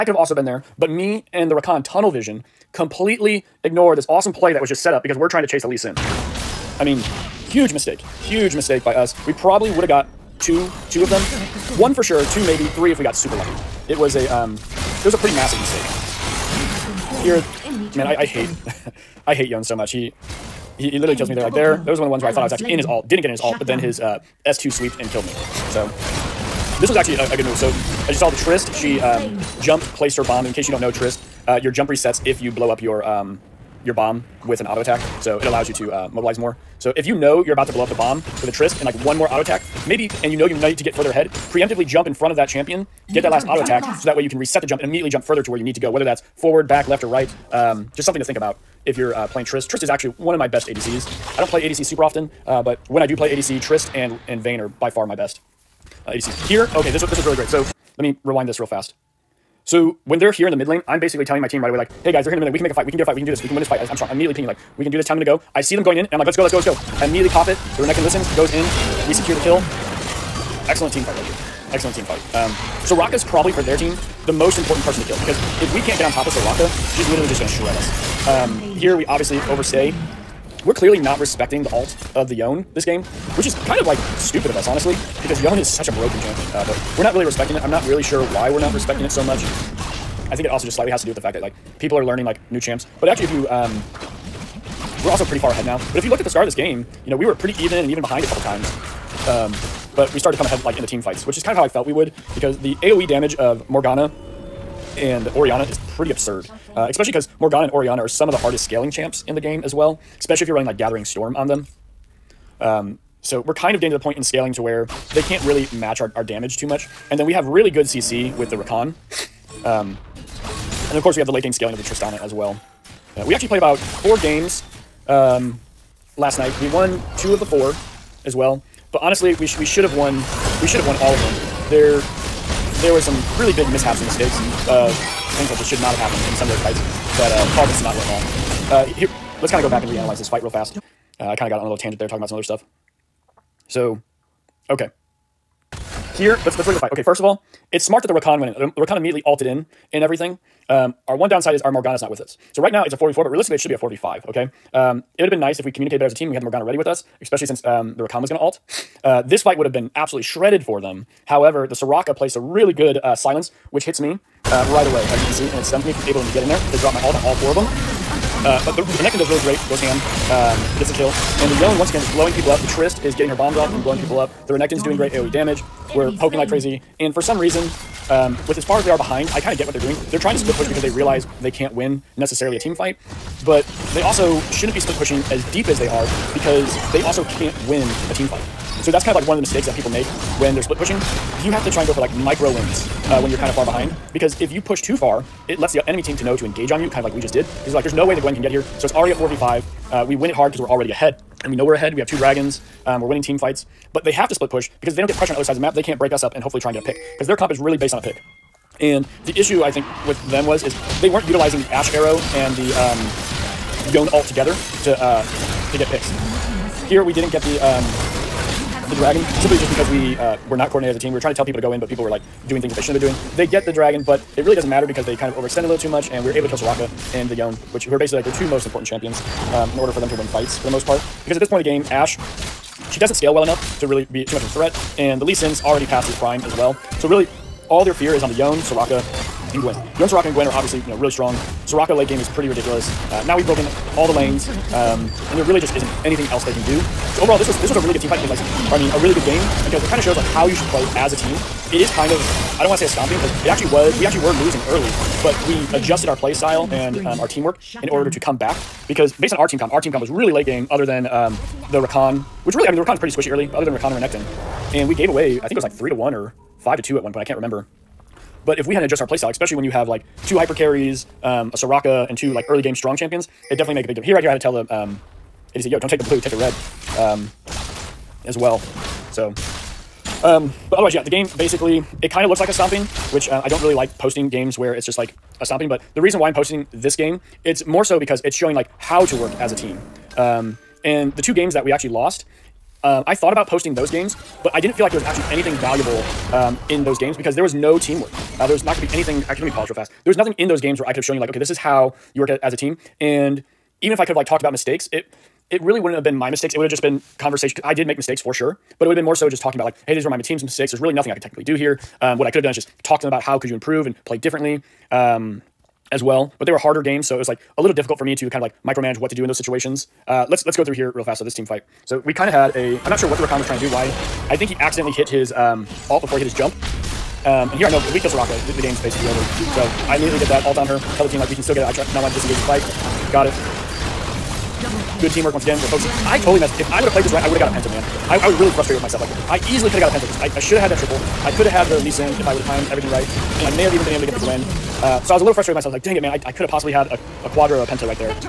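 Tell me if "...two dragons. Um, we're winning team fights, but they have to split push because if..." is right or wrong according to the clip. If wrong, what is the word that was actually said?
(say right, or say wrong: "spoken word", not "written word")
right.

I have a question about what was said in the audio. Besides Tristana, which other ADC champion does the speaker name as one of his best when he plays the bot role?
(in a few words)
Vayne.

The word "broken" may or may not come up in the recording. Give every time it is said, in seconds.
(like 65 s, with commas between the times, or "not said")
85 s, 243 s.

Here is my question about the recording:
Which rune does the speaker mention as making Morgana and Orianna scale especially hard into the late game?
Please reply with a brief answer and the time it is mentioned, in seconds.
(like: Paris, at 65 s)
Gathering Storm, at 110 s.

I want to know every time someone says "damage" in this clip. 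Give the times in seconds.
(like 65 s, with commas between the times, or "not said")
103 s, 116 s, 175 s.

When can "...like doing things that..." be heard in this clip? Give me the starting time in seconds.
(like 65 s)
222 s.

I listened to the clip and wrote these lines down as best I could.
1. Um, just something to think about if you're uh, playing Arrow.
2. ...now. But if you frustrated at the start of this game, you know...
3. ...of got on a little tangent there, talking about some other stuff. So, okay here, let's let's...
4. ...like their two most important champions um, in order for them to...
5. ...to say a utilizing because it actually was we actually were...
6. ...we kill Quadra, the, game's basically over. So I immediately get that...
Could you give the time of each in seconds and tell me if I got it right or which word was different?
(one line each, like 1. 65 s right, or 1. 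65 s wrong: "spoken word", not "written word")
1. 47 s wrong: "Trist", not "Arrow"
2. 95 s wrong: "looked", not "frustrated"
3. 141 s right
4. 228 s right
5. 252 s wrong: "stomping", not "utilizing"
6. 327 s wrong: "Soraka", not "Quadra".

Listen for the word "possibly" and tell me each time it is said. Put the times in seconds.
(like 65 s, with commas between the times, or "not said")
346 s.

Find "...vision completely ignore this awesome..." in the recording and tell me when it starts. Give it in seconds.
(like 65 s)
2 s.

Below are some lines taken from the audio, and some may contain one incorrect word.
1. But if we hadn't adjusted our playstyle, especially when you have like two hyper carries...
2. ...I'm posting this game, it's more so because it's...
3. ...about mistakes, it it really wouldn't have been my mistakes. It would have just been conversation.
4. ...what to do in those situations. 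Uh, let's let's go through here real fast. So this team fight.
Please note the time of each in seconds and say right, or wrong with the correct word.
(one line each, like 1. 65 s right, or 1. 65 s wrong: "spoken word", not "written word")
1. 268 s right
2. 286 s right
3. 304 s right
4. 318 s right.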